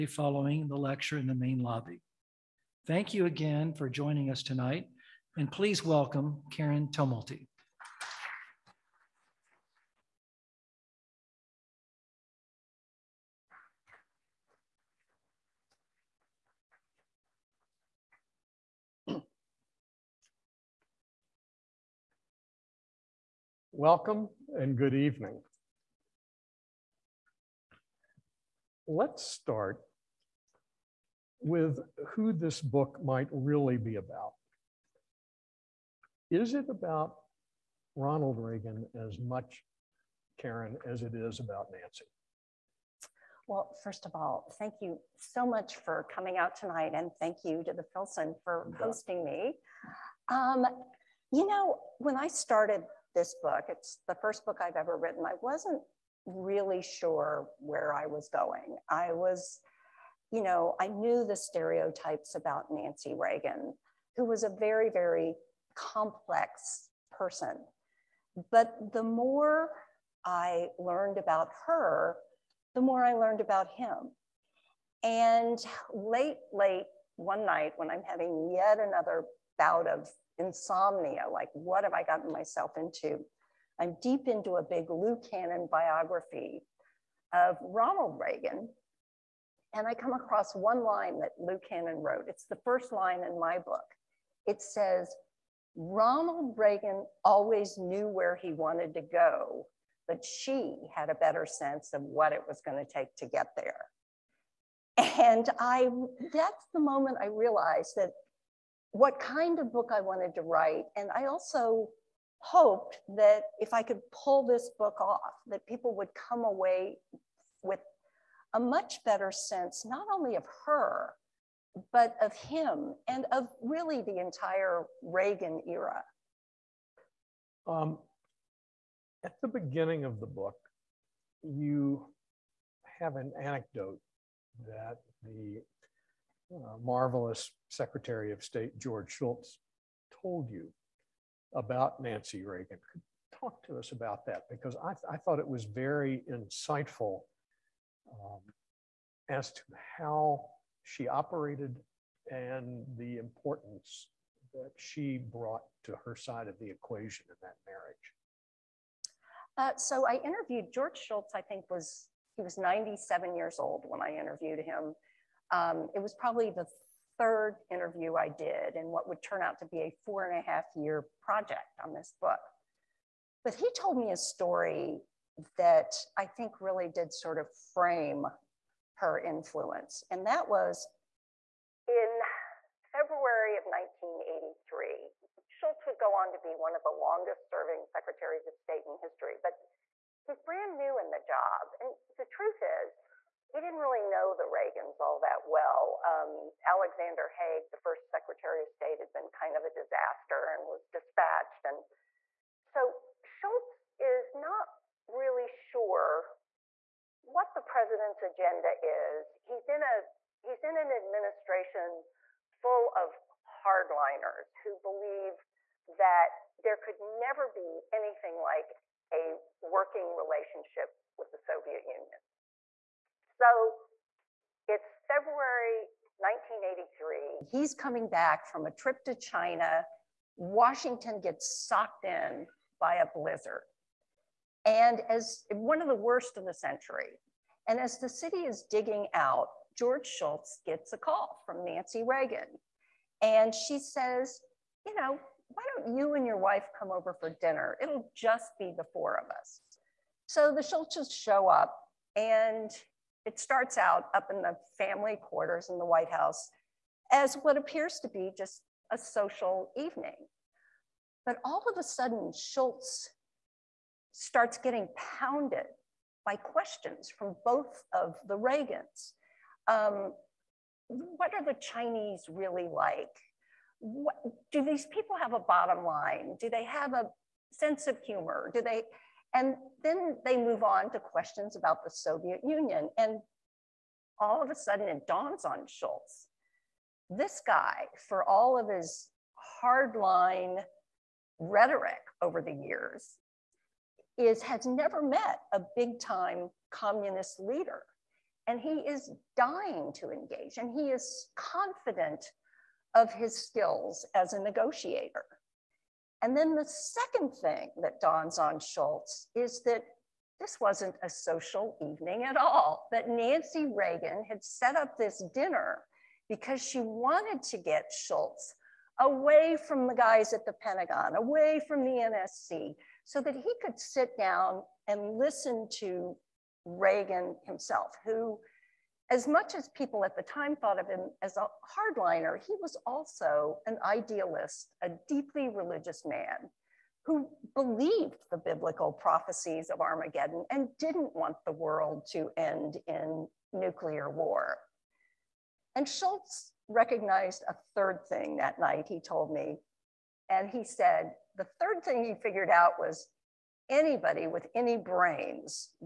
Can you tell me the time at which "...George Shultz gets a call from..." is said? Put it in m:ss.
3:59.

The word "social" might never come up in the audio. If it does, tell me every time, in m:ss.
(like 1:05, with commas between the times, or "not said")
4:18, 5:11.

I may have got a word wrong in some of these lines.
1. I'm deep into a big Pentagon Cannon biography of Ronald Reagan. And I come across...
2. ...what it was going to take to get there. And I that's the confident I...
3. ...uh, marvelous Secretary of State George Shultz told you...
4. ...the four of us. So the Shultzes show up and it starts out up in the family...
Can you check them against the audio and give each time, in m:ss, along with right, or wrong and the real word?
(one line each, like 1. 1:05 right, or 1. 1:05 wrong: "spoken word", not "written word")
1. 1:23 wrong: "Lou", not "Pentagon"
2. 1:42 wrong: "moment", not "confident"
3. 2:16 right
4. 4:08 right.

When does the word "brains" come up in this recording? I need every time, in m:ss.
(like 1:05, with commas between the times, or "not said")
5:54.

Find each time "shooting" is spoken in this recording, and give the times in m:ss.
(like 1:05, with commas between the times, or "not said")
not said.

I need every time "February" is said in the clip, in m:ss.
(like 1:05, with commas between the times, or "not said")
3:02, 3:45.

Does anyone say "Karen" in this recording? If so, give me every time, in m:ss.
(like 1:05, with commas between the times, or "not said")
0:06, 0:40.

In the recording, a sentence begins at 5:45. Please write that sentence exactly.
And Shultz recognized a third thing that night, he told me.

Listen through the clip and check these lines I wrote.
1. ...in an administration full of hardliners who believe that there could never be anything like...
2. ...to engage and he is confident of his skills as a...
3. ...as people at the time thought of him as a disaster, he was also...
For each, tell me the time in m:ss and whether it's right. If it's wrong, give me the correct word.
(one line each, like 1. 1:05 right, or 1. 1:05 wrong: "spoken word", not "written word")
1. 3:30 right
2. 4:59 right
3. 5:29 wrong: "hardliner", not "disaster".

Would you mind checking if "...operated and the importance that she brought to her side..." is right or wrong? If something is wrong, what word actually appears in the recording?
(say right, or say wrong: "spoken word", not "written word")
right.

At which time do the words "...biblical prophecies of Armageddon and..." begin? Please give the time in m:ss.
5:38.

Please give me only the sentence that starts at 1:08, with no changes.
But the more I learned about her, the more I learned about him.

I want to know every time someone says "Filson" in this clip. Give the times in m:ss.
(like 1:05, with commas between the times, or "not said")
0:47.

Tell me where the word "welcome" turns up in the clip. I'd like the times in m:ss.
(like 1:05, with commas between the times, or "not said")
0:05, 0:23.